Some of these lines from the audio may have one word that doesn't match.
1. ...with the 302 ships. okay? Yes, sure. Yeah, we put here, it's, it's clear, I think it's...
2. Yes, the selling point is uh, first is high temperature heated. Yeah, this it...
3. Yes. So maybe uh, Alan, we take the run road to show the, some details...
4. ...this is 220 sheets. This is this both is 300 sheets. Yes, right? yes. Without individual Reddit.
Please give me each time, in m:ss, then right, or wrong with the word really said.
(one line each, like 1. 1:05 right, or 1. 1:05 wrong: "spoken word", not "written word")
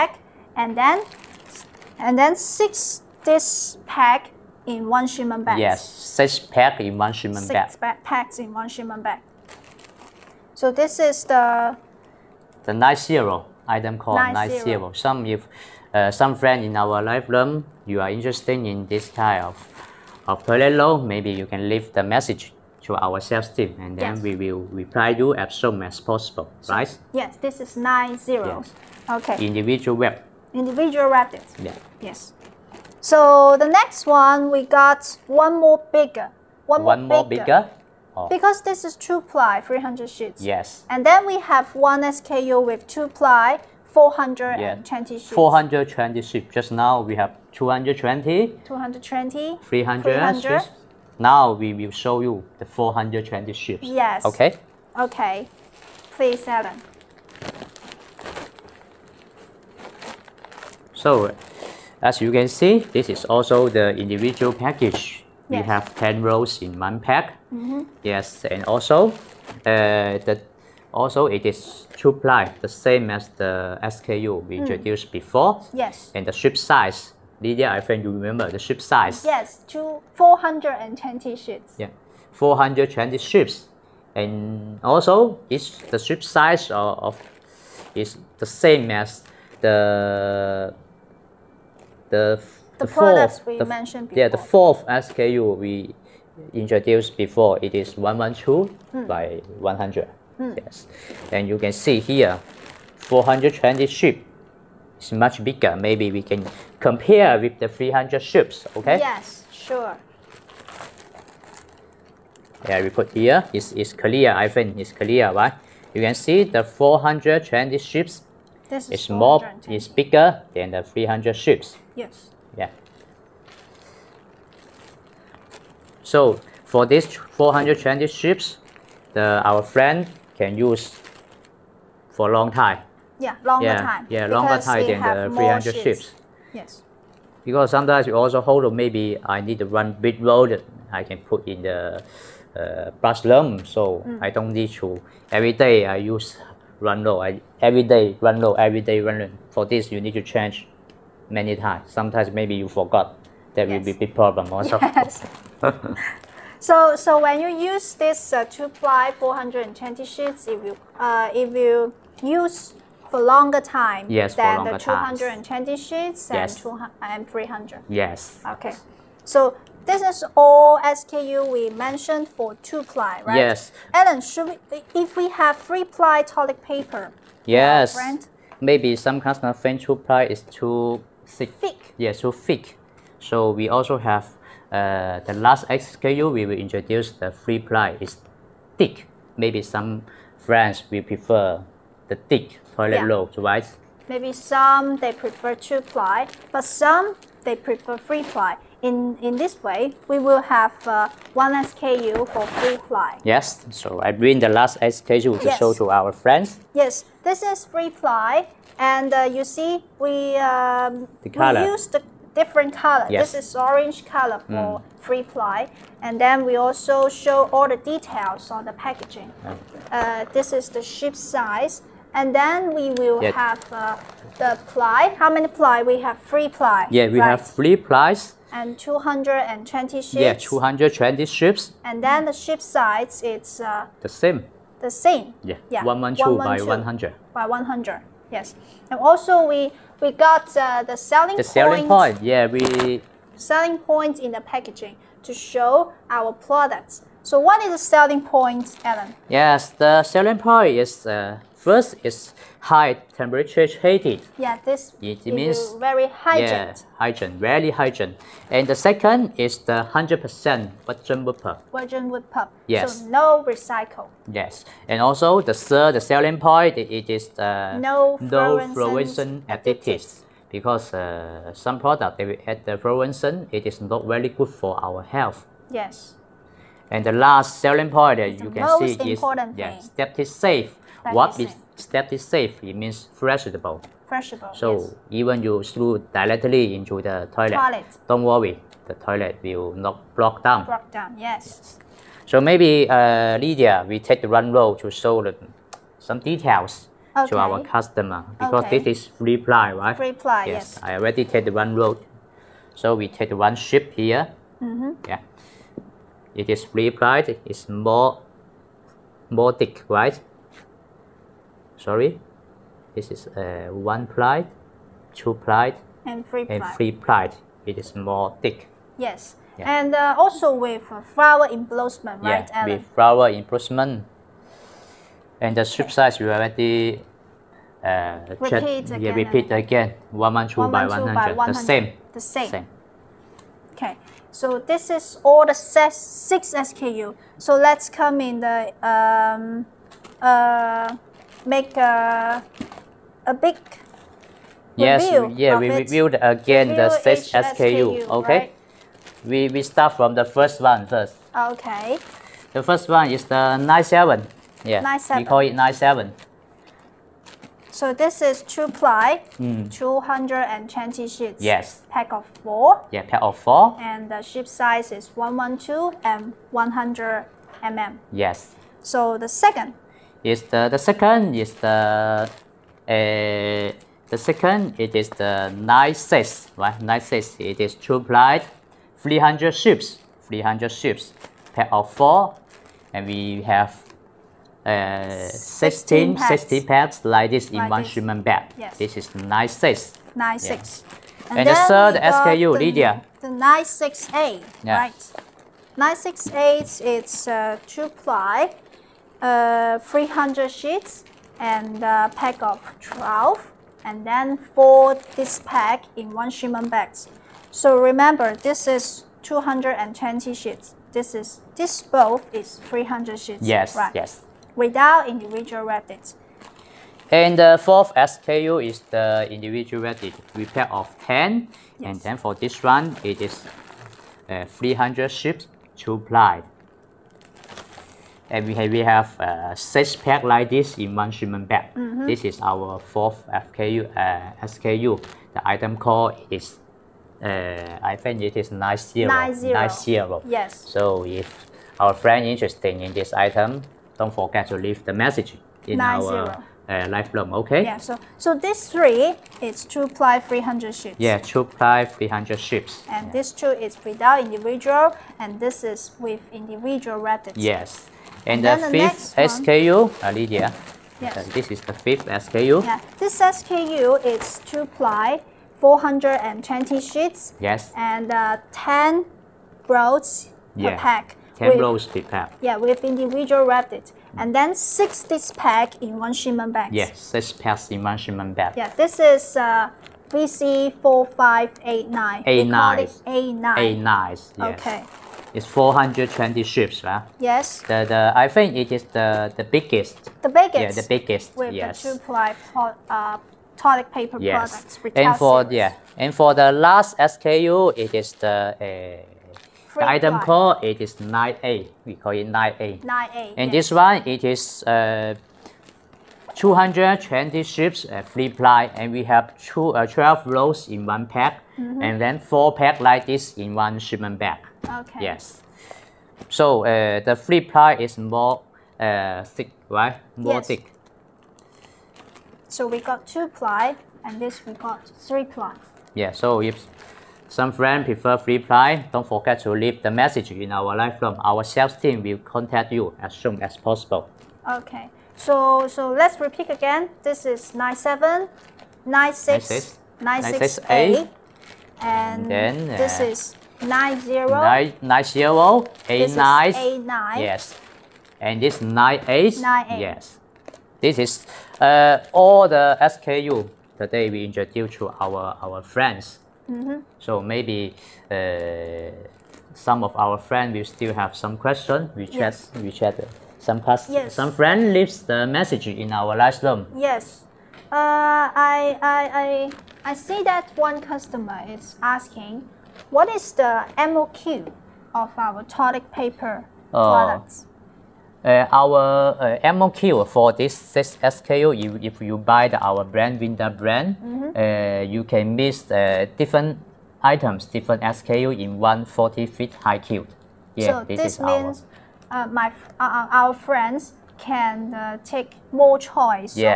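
1. 1:47 wrong: "300", not "302"
2. 4:09 right
3. 4:51 wrong: "Lydia", not "Alan"
4. 6:48 right.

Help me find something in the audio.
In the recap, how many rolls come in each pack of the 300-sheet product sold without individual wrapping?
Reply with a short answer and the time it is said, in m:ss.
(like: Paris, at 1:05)
12, at 6:41.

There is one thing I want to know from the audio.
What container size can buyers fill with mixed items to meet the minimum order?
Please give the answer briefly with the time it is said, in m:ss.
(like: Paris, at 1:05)
40-foot high cube, at 9:48.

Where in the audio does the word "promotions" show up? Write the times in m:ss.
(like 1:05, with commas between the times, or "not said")
not said.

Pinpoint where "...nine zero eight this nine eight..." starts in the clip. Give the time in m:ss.
9:04.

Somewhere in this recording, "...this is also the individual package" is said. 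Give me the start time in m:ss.
1:02.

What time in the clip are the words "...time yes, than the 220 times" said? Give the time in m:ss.
2:43.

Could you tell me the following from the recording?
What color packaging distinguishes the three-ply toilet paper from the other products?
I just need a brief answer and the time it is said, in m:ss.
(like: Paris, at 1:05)
Orange, at 3:33.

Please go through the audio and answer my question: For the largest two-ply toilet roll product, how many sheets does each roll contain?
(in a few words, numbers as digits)
420.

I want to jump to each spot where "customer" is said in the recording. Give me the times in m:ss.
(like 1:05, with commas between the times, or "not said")
2:59, 4:57, 9:30.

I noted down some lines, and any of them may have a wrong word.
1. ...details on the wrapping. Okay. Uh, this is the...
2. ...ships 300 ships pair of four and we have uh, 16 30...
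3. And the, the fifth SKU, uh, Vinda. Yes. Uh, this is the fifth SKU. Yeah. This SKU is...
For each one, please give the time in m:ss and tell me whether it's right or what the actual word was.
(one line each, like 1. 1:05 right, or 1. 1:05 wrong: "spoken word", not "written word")
1. 3:37 wrong: "packaging", not "wrapping"
2. 6:19 wrong: "60", not "30"
3. 7:38 wrong: "Lydia", not "Vinda".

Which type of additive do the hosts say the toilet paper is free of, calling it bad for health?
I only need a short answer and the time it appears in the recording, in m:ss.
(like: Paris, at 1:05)
Fluorescent additives, at 4:28.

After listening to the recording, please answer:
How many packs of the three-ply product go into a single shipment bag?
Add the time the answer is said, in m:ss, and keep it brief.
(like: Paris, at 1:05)
4, at 8:32.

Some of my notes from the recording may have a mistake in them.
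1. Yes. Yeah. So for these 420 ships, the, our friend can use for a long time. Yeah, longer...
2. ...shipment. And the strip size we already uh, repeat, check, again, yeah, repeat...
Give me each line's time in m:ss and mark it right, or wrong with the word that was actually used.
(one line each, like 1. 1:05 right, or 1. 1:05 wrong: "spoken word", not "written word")
1. 2:01 right
2. 5:23 wrong: "embossment", not "shipment".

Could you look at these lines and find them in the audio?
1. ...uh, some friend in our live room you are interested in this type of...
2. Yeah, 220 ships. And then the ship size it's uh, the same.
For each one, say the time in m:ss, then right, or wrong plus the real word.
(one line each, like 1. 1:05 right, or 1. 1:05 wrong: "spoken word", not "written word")
1. 0:15 right
2. 3:50 right.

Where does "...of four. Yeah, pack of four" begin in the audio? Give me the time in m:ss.
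6:02.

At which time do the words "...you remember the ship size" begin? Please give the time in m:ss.
1:18.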